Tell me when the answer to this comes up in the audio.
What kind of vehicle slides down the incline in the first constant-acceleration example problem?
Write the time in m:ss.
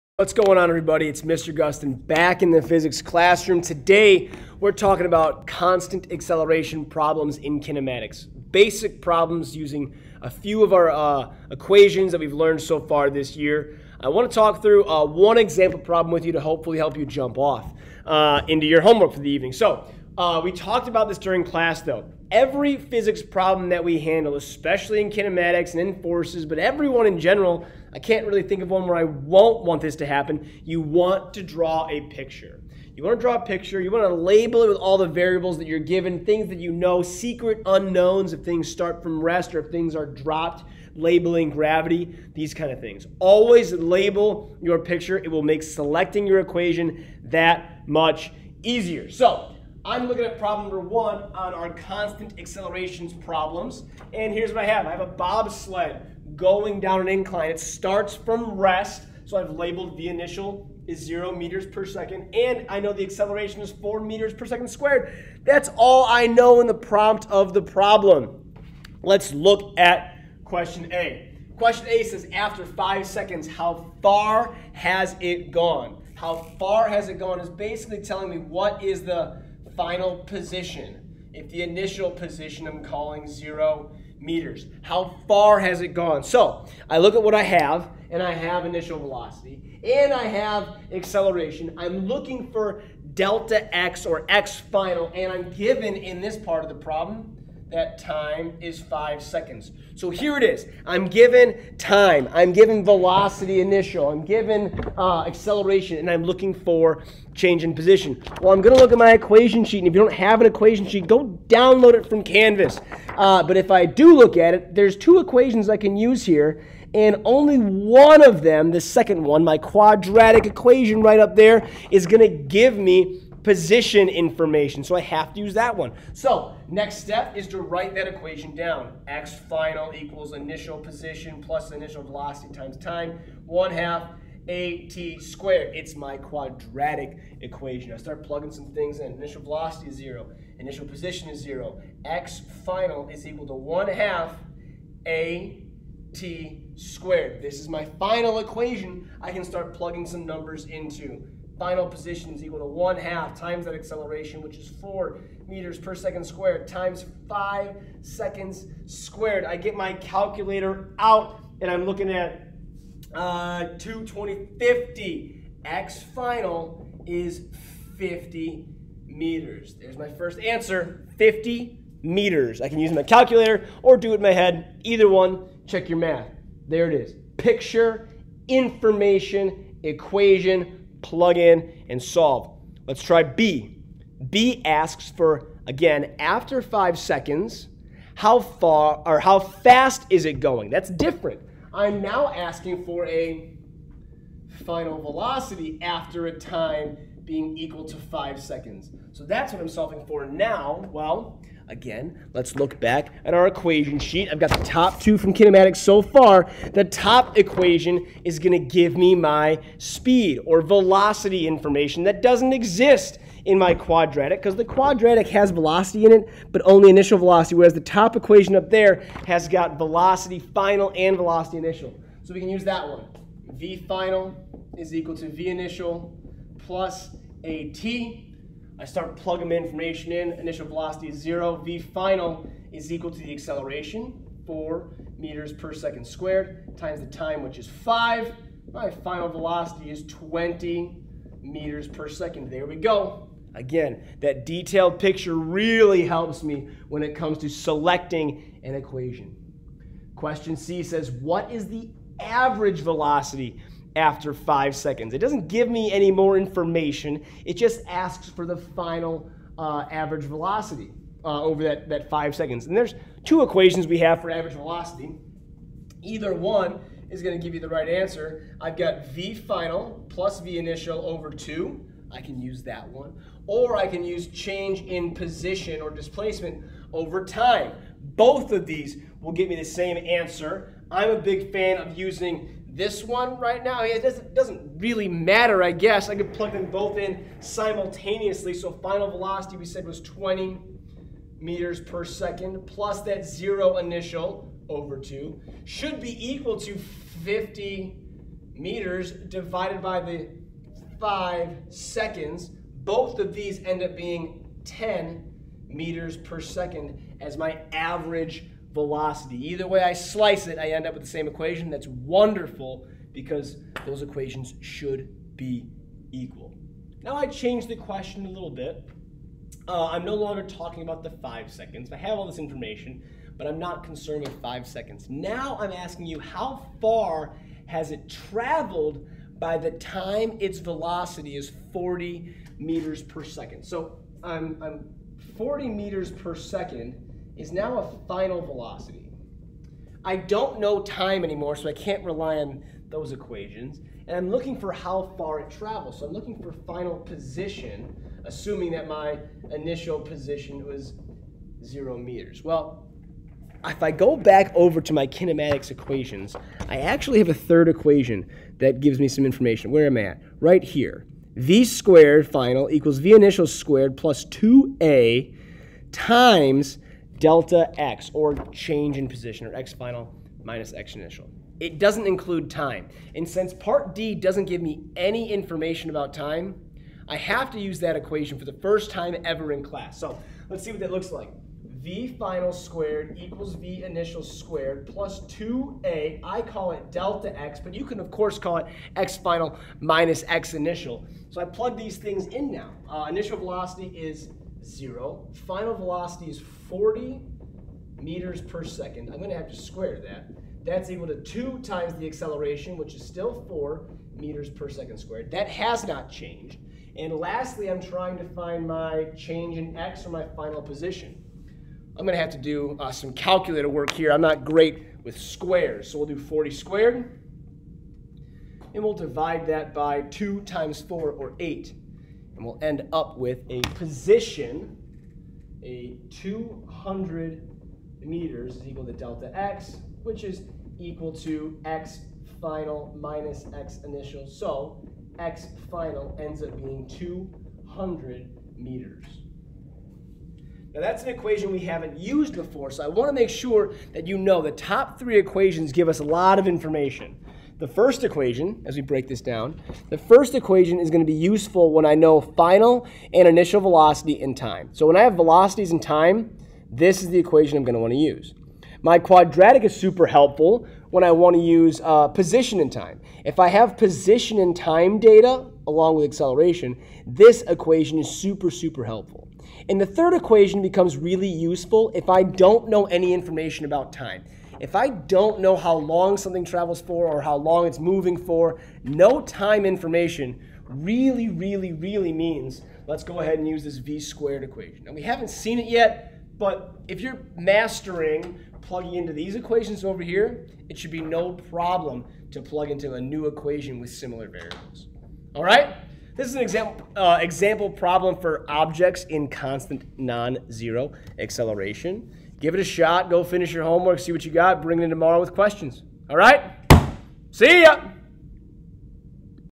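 0:55.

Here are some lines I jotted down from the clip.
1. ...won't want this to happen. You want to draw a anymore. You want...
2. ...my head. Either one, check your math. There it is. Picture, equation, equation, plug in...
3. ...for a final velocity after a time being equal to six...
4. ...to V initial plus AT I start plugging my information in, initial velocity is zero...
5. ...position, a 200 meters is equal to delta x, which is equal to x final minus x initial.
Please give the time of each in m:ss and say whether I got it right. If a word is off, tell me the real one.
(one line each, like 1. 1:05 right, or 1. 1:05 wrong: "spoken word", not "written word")
1. 0:29 wrong: "picture", not "anymore"
2. 2:54 wrong: "information", not "equation"
3. 3:12 wrong: "five", not "six"
4. 3:45 right
5. 7:03 right.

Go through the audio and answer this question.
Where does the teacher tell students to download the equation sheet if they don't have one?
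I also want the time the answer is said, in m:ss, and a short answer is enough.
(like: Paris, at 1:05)
Canvas, at 1:52.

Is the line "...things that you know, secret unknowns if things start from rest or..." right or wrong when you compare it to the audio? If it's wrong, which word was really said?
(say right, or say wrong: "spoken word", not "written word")
right.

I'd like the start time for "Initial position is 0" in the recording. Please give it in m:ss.
2:20.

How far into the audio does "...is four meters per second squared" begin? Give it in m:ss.
1:03.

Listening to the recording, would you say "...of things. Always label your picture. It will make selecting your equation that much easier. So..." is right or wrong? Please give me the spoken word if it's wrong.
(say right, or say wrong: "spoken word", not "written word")
right.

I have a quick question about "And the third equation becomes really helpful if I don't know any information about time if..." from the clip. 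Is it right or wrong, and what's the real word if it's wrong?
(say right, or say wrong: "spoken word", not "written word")
wrong: "useful", not "helpful".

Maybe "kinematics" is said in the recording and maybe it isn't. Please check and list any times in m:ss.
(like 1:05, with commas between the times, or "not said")
0:07, 0:25, 3:25, 5:55.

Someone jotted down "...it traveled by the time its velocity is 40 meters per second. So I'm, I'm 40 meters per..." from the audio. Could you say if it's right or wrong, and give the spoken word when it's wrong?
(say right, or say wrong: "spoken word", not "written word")
right.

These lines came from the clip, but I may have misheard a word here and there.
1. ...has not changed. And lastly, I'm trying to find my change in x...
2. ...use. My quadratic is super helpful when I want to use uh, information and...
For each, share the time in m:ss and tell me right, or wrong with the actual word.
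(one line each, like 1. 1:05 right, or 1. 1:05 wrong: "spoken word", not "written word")
1. 6:45 right
2. 7:37 wrong: "position", not "information".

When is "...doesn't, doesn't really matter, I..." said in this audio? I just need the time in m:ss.
4:44.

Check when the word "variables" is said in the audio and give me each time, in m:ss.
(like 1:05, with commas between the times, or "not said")
0:35, 8:14.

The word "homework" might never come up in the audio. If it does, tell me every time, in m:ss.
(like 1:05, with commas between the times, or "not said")
0:18, 8:23.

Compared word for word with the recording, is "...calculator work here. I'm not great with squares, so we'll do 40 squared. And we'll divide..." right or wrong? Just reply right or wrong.
right.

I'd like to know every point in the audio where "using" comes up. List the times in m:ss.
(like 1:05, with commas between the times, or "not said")
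0:09, 4:41.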